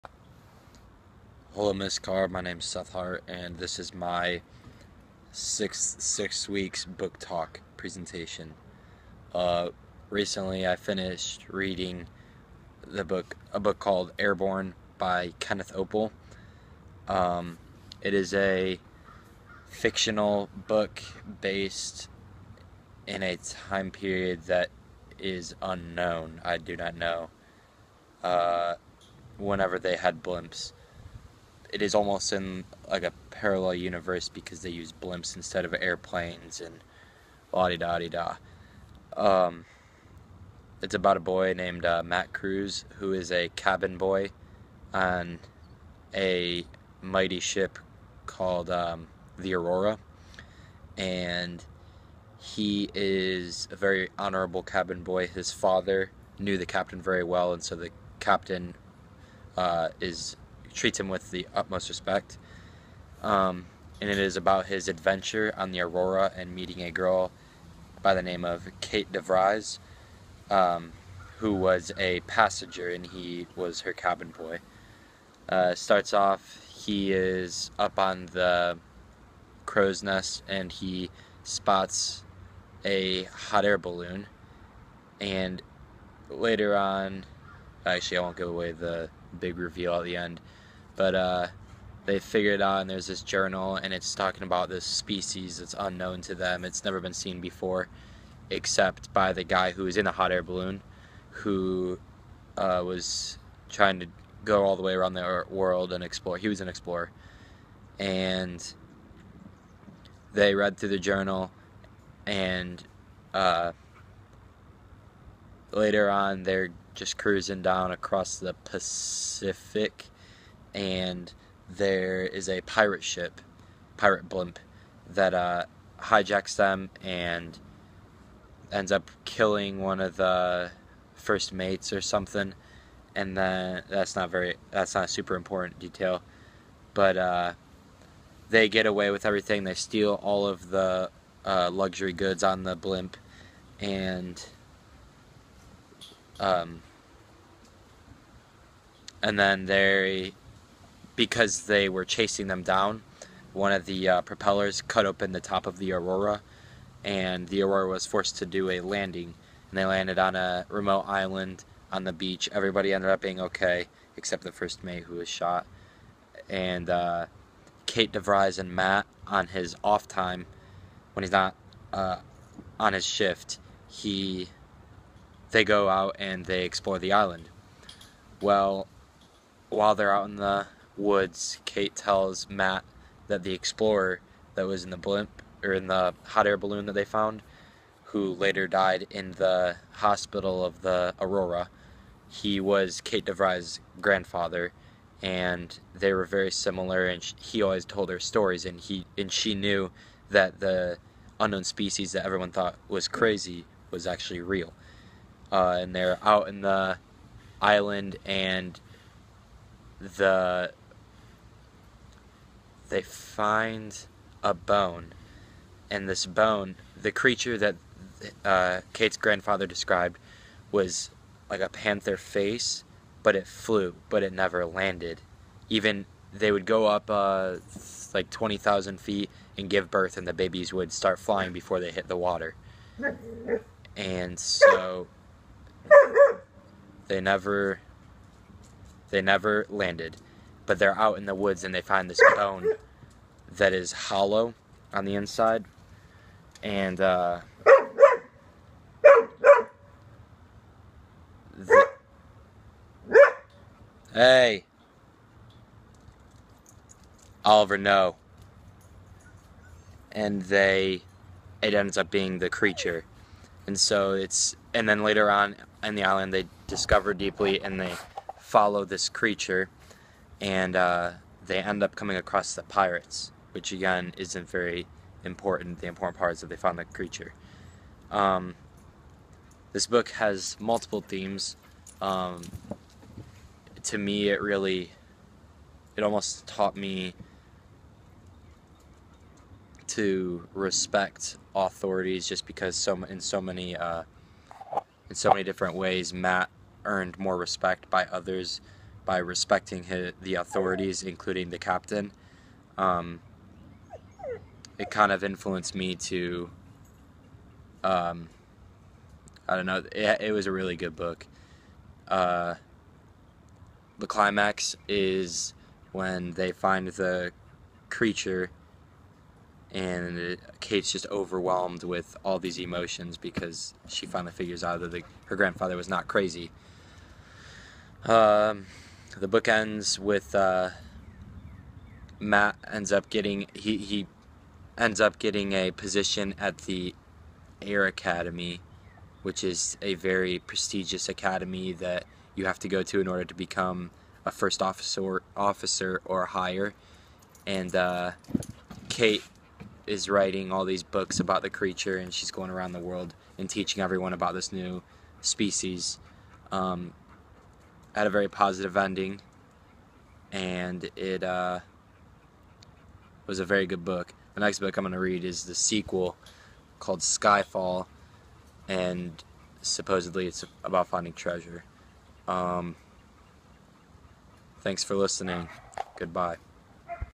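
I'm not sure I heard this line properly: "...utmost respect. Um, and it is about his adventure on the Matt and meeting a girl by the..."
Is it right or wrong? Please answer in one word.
wrong.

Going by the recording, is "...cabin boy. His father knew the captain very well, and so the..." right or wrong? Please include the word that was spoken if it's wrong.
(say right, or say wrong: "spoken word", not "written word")
right.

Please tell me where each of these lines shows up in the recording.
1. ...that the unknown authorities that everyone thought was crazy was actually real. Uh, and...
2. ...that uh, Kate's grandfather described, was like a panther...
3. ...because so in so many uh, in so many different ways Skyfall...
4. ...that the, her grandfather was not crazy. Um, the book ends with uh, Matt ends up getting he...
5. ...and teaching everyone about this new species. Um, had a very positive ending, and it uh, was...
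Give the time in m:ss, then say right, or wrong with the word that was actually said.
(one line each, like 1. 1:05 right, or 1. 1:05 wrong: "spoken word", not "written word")
1. 3:20 wrong: "species", not "authorities"
2. 3:37 right
3. 4:52 wrong: "Matt", not "Skyfall"
4. 5:24 right
5. 5:53 right.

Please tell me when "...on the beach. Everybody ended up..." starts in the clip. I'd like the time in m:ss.
2:41.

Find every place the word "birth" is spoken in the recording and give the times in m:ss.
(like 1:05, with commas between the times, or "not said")
3:49.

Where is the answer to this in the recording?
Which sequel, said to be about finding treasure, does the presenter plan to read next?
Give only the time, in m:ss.
6:07.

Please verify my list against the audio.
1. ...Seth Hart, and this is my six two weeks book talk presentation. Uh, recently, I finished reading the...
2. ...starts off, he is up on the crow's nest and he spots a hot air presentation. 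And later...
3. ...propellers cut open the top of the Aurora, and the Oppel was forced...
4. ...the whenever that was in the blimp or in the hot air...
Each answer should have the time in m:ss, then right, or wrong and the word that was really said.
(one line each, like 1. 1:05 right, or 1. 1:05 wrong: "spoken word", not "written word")
1. 0:02 wrong: "six", not "two"
2. 1:15 wrong: "balloon", not "presentation"
3. 2:34 wrong: "Aurora", not "Oppel"
4. 3:03 wrong: "explorer", not "whenever".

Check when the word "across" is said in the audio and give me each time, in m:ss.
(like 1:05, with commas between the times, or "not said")
1:57, 4:32.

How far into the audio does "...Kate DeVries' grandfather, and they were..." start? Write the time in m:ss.
3:13.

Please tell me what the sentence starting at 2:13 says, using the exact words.
And then that's not very that's not a super important detail, but uh, they get away with everything.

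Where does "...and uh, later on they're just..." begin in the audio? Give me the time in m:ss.
1:52.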